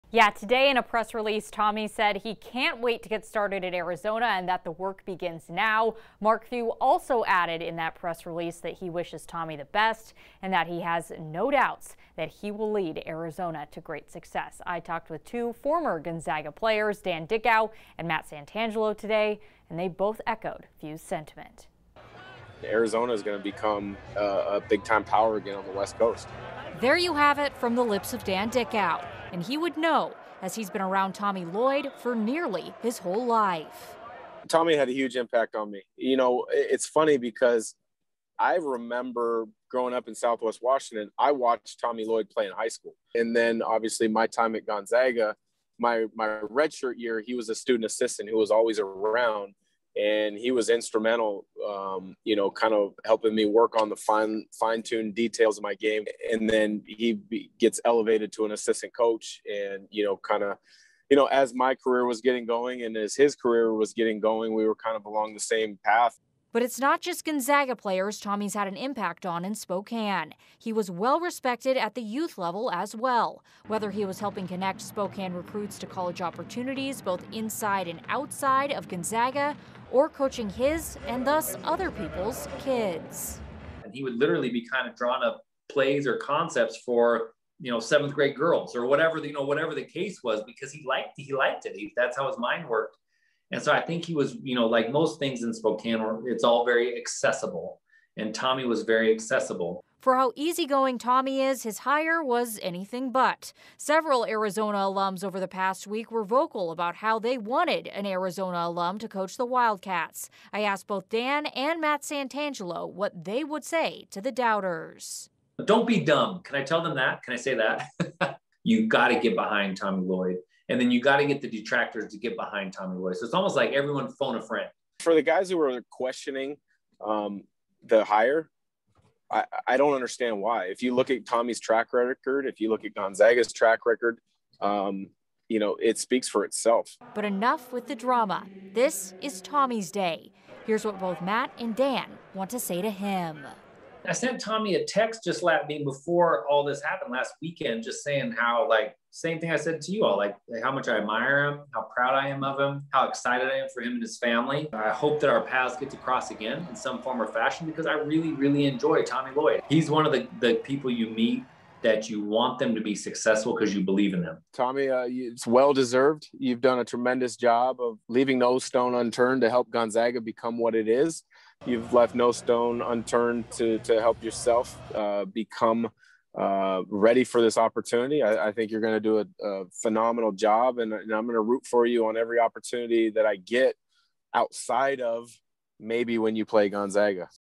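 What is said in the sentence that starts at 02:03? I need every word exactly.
So it's almost like everyone phone a friend.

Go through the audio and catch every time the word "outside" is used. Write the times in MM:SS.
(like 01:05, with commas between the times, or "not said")
01:18, 03:04.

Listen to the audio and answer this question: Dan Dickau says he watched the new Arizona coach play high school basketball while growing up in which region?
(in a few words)
Southwest Washington.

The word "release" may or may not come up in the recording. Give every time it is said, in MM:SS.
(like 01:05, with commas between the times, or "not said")
00:01, 00:08.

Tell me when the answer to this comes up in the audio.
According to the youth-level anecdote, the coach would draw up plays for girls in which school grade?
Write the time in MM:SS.
01:27.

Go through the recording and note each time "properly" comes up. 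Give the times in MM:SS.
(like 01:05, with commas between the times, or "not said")
not said.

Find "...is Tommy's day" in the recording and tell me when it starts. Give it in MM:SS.
02:19.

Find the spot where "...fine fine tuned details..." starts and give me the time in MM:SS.
00:53.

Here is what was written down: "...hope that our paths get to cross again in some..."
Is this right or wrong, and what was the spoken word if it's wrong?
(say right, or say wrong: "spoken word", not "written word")
right.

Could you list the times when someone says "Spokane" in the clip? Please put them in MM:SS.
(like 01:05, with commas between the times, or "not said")
01:09, 01:14, 01:35.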